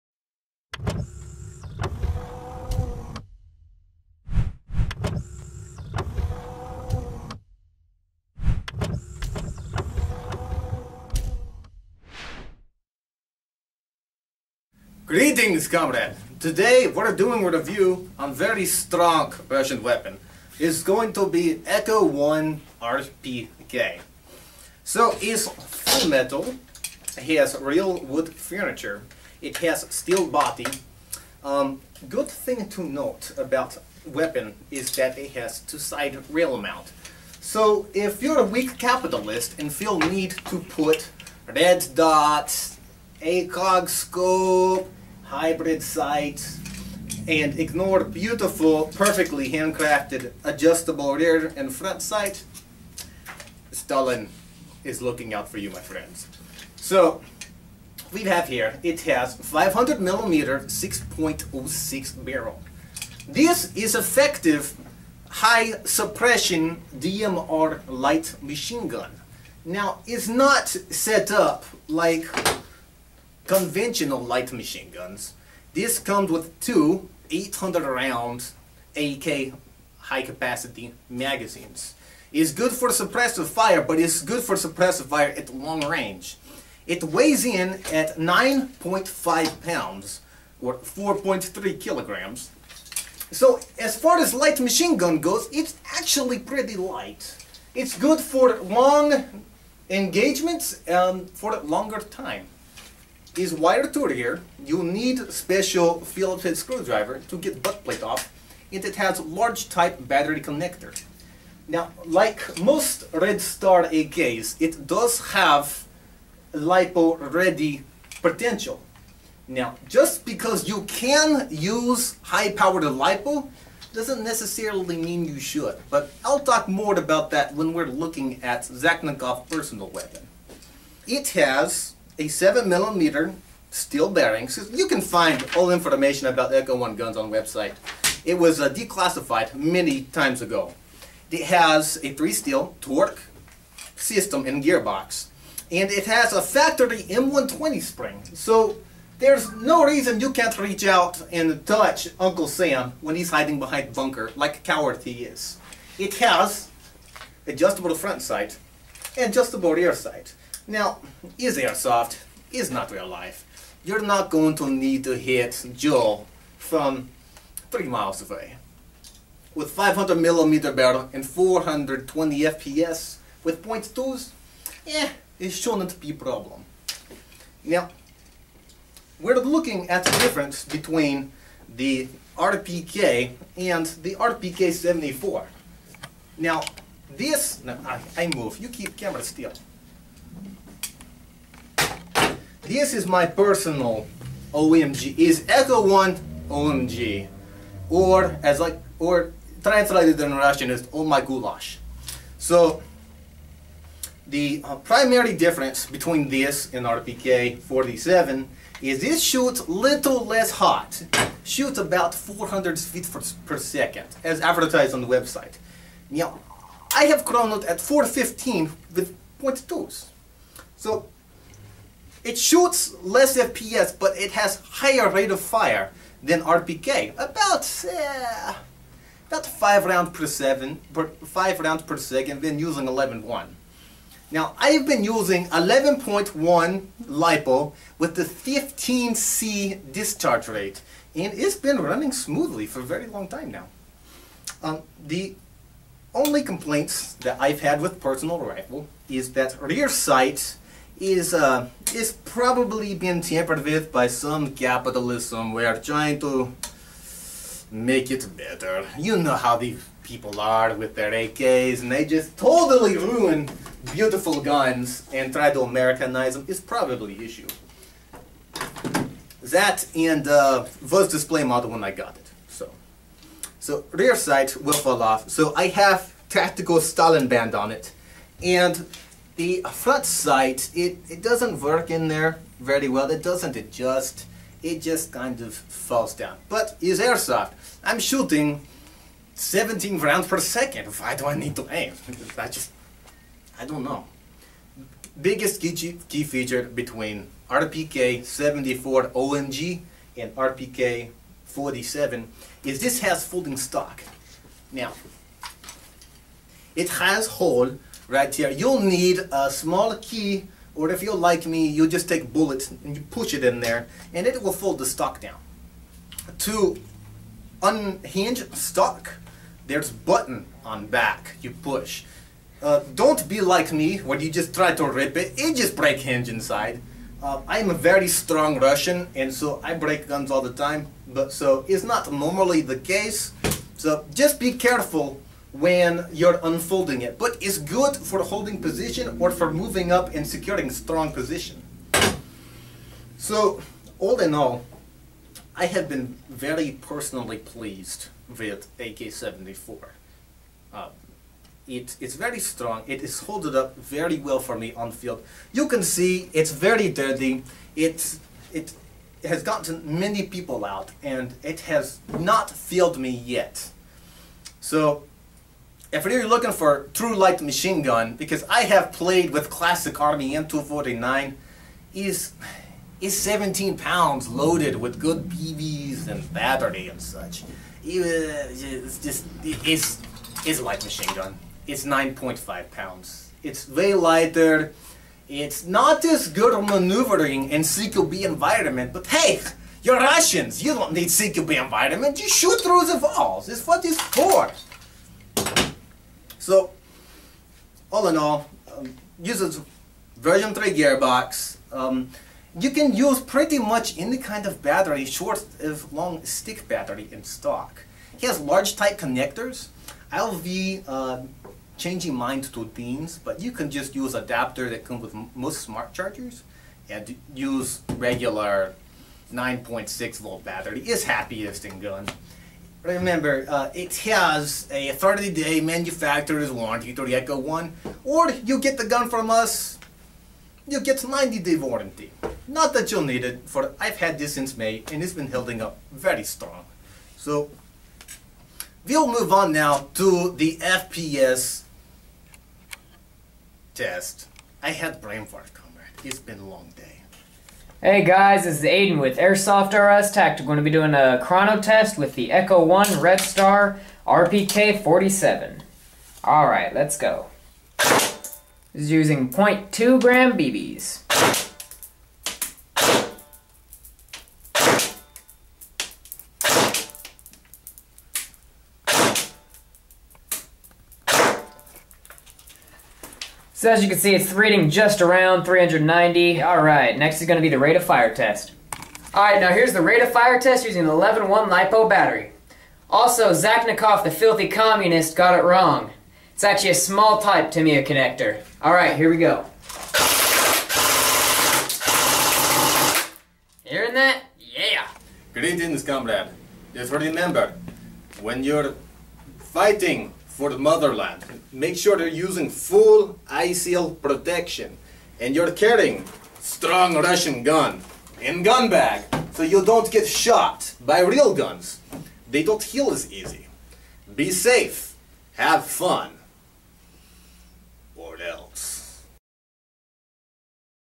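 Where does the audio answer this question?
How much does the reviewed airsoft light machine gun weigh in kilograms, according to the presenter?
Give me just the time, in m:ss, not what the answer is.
1:30.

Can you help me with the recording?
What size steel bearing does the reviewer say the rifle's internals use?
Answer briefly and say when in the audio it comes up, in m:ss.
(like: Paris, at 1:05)
7 millimeter, at 2:12.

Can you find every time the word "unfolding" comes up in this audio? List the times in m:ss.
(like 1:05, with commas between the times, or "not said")
5:36.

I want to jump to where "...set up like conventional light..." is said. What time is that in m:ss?
1:10.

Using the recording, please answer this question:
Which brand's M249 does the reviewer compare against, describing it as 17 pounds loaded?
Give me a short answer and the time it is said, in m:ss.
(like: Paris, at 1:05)
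Classic Army, at 6:09.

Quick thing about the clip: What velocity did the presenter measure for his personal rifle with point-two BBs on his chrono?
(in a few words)
415.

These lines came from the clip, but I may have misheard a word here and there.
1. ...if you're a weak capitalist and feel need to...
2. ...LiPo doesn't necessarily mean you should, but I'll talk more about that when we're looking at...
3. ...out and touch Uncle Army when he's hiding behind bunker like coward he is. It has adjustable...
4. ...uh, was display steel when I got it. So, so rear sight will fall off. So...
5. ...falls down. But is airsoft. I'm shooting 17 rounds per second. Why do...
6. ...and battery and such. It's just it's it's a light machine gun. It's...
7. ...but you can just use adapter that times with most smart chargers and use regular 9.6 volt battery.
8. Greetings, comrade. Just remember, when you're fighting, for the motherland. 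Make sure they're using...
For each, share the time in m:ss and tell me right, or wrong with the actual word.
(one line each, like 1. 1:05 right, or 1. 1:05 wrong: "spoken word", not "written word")
1. 0:37 right
2. 2:02 right
3. 2:30 wrong: "Sam", not "Army"
4. 4:30 wrong: "model", not "steel"
5. 4:45 right
6. 6:16 right
7. 6:53 wrong: "comes", not "times"
8. 8:15 right.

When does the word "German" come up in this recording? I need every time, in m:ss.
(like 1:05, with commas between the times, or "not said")
not said.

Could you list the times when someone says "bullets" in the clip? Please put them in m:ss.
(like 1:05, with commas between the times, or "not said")
5:12.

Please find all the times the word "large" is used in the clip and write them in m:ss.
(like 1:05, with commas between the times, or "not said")
1:49, 6:48.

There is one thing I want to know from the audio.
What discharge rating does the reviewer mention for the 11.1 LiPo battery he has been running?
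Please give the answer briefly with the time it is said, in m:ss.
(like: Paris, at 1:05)
15C, at 3:58.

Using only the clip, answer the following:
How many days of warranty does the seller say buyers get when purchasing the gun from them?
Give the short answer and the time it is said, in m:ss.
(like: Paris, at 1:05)
90 days, at 7:10.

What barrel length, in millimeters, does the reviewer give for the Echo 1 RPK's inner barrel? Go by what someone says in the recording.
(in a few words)
500 millimeter.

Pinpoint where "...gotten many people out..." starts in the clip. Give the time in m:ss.
5:59.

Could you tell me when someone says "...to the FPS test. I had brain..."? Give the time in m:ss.
7:19.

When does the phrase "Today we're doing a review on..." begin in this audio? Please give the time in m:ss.
0:16.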